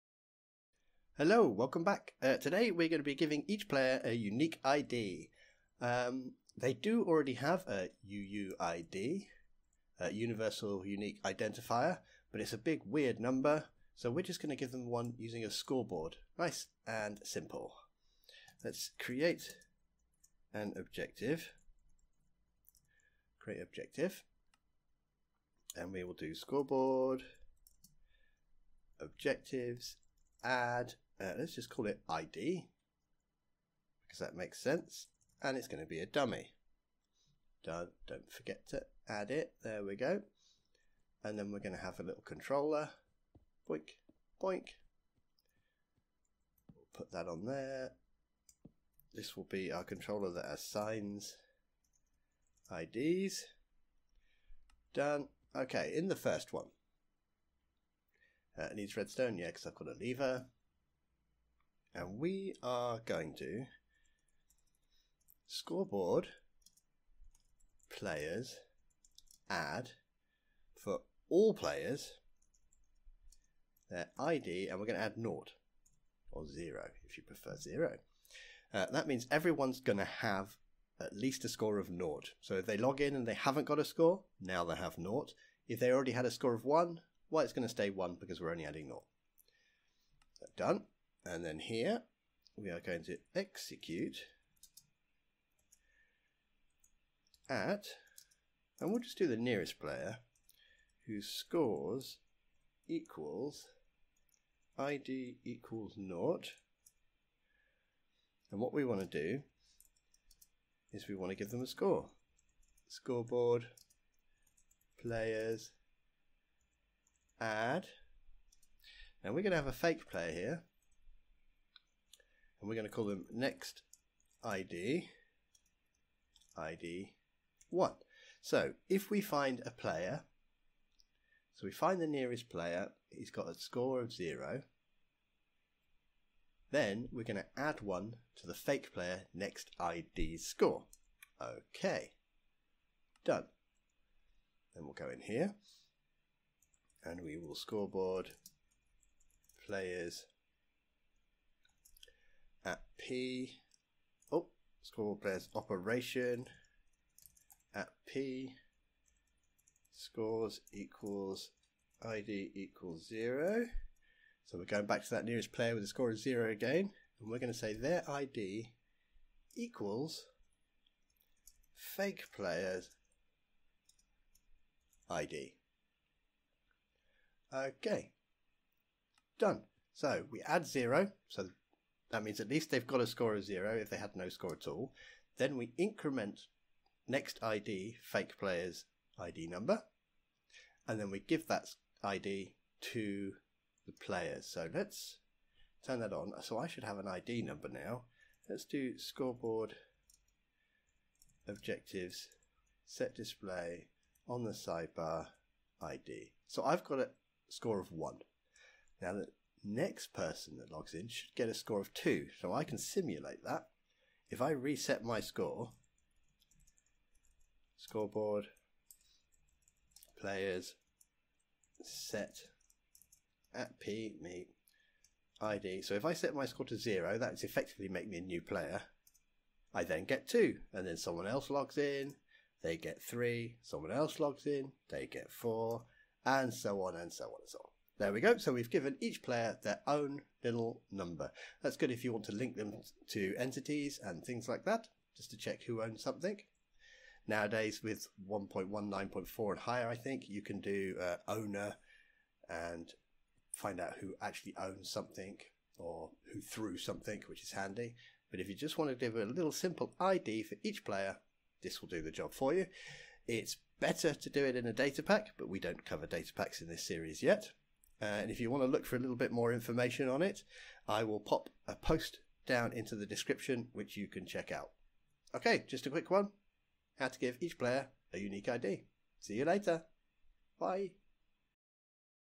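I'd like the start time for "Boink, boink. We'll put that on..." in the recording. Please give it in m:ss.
0:43.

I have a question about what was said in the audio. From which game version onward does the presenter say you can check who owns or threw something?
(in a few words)
1.19.4.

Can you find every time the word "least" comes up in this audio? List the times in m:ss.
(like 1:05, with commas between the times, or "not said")
1:21, 3:02.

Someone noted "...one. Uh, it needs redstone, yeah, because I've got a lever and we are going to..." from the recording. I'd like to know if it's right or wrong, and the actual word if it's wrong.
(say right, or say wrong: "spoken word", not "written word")
right.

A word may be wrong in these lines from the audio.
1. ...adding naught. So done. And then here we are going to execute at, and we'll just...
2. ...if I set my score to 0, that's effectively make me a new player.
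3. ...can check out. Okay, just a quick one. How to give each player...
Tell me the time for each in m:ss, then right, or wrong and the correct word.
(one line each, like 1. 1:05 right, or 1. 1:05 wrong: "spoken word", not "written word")
1. 1:28 right
2. 3:45 right
3. 4:34 right.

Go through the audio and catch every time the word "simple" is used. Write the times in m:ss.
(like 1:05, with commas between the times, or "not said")
0:17, 4:19.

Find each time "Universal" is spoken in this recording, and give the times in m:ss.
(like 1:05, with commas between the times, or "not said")
0:10.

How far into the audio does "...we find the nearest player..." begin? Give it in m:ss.
2:11.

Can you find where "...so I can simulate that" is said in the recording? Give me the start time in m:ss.
3:32.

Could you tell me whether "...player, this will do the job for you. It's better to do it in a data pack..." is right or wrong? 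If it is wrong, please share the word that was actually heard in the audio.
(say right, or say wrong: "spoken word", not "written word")
right.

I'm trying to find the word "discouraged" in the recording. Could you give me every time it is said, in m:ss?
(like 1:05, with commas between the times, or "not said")
not said.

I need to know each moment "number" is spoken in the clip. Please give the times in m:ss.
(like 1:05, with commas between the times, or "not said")
0:13, 3:09, 3:17, 4:00.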